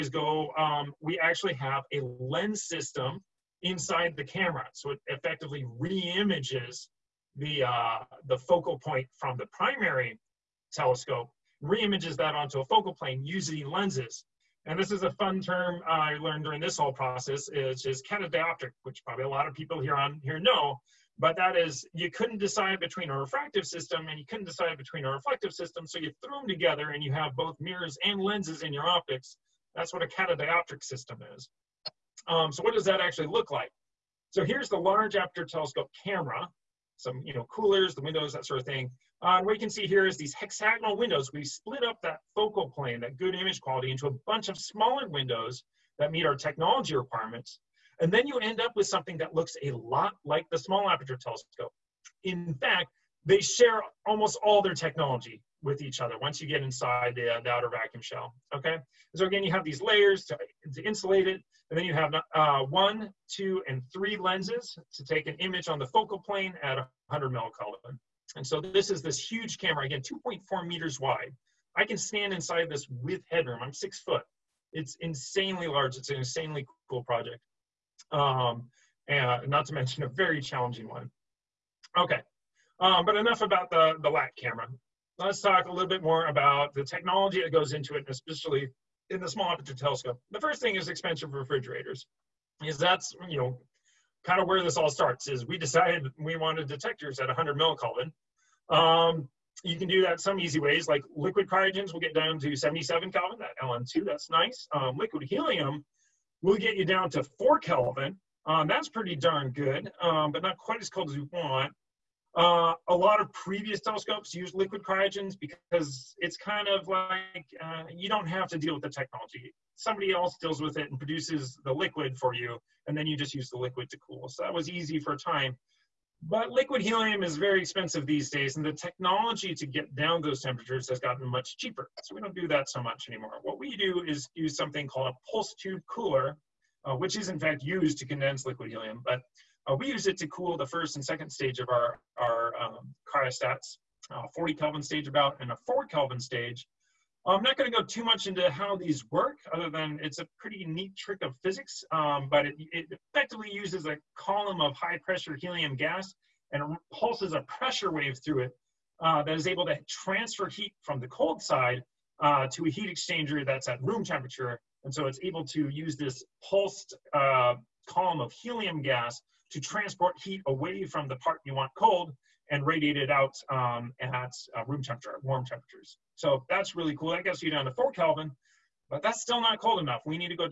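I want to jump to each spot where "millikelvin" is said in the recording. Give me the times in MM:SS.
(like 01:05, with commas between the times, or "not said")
01:07, 01:37.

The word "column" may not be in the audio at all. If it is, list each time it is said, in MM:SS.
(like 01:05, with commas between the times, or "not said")
02:34, 02:47.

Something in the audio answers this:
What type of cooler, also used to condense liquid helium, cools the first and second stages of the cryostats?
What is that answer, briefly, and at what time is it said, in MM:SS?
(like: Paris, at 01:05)
pulse tube cooler, at 02:15.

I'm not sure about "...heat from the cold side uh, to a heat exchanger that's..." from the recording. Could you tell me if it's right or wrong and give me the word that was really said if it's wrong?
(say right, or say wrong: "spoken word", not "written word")
right.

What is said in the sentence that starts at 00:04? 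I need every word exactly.
So it effectively re-images the, uh, the focal point from the primary telescope, re-images that onto a focal plane using lenses.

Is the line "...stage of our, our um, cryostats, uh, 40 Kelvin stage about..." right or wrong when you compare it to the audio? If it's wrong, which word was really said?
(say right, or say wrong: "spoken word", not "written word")
right.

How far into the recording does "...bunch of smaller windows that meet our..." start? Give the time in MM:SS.
00:44.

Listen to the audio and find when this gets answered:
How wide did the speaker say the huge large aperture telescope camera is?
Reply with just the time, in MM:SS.
01:10.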